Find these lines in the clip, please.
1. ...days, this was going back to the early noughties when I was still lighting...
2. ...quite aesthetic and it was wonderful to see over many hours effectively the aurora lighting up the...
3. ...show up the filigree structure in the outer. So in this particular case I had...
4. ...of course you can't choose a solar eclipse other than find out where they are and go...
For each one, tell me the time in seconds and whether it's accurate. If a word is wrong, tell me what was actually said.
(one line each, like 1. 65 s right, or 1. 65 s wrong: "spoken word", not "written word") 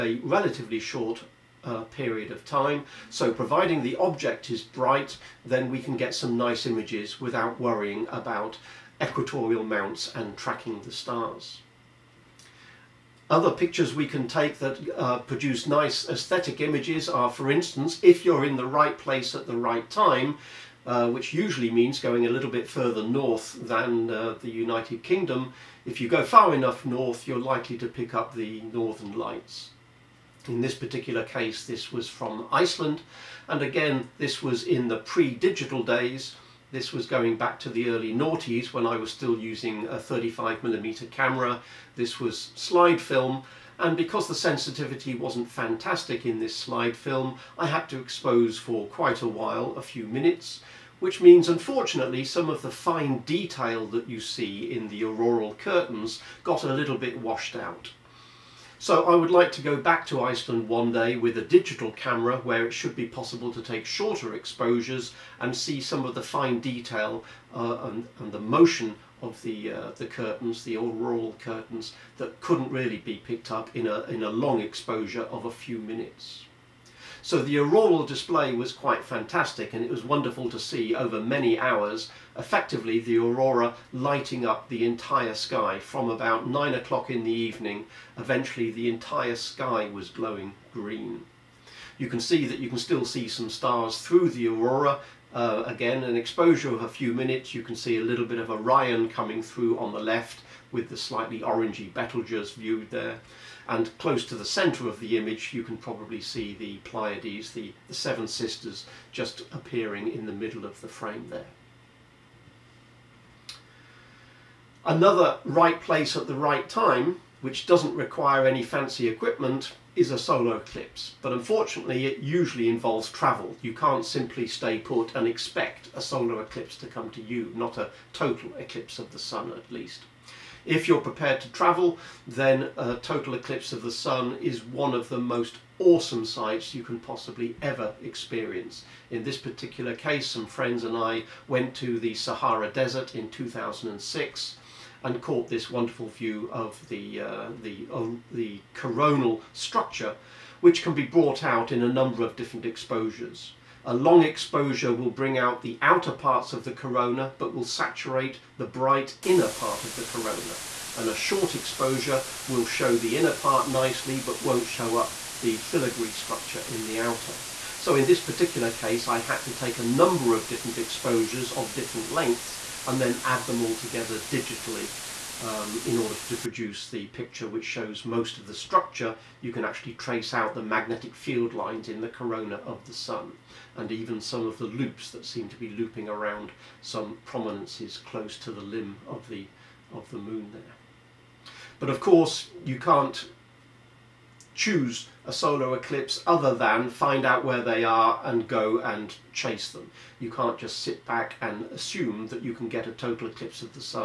1. 35 s wrong: "using", not "lighting"
2. 78 s wrong: "fantastic", not "aesthetic"
3. 164 s right
4. 191 s right.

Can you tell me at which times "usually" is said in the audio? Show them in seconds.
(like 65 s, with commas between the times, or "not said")
21 s, 122 s.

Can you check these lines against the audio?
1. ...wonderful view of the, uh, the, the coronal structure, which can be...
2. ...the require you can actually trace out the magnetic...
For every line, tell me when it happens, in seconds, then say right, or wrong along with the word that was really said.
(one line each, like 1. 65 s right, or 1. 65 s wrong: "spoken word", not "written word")
1. 145 s right
2. 178 s wrong: "structure", not "require".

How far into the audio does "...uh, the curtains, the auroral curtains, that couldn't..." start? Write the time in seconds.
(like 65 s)
69 s.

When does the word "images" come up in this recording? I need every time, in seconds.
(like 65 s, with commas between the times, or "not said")
6 s, 16 s, 105 s.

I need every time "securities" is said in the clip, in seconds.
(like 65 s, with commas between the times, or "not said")
not said.